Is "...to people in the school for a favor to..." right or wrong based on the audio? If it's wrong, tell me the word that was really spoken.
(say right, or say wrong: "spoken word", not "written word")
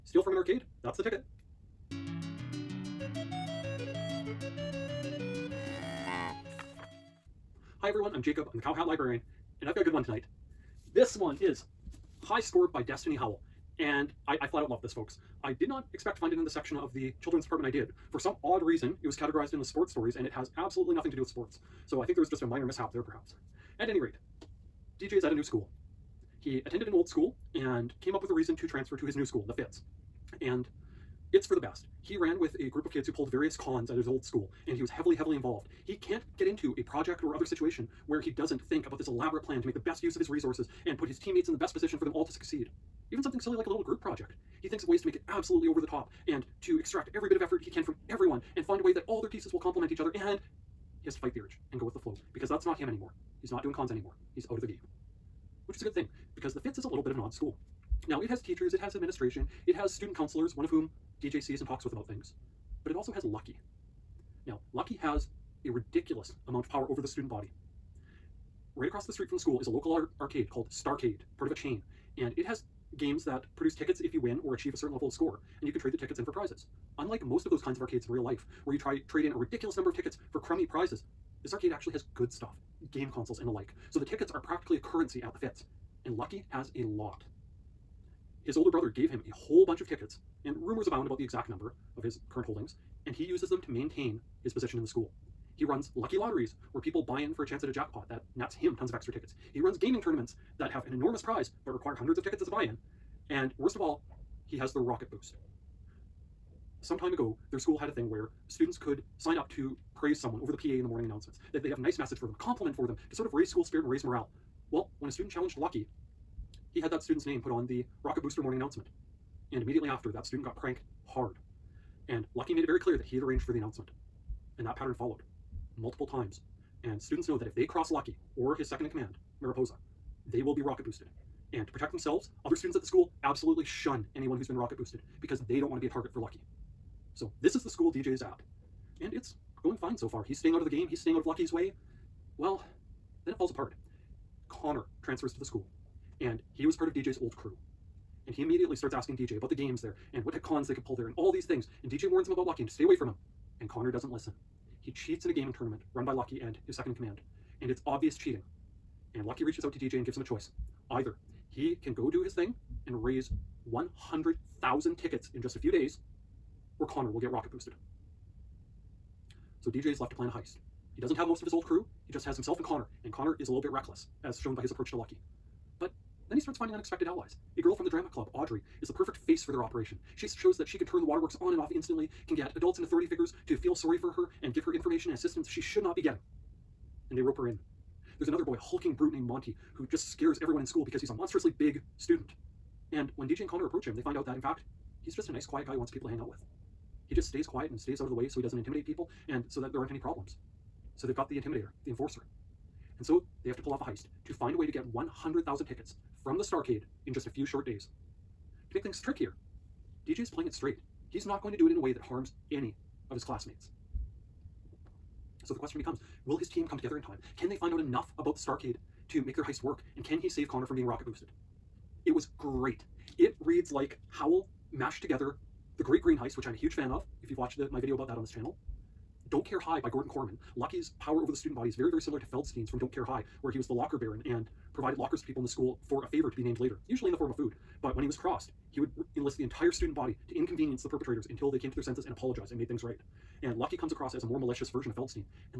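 right.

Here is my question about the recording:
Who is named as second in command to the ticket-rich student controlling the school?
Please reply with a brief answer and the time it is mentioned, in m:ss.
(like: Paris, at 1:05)
Mariposa, at 2:09.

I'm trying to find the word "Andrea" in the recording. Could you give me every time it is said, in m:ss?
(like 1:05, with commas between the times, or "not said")
not said.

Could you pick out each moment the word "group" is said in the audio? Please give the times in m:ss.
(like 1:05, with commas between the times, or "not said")
0:32, 0:43.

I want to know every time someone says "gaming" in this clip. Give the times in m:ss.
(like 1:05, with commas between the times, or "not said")
1:39, 2:35.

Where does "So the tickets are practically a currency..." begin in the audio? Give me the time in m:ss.
1:23.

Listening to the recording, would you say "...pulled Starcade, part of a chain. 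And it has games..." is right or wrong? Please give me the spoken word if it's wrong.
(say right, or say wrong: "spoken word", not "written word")
wrong: "called", not "pulled".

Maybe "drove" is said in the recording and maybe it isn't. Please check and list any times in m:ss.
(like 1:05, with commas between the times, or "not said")
not said.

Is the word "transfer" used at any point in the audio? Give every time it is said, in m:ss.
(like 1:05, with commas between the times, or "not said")
0:28, 2:25.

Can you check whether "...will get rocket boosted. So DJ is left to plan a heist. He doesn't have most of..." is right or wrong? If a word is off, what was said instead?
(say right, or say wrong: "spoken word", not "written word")
right.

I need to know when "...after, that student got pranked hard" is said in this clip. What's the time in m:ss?
1:59.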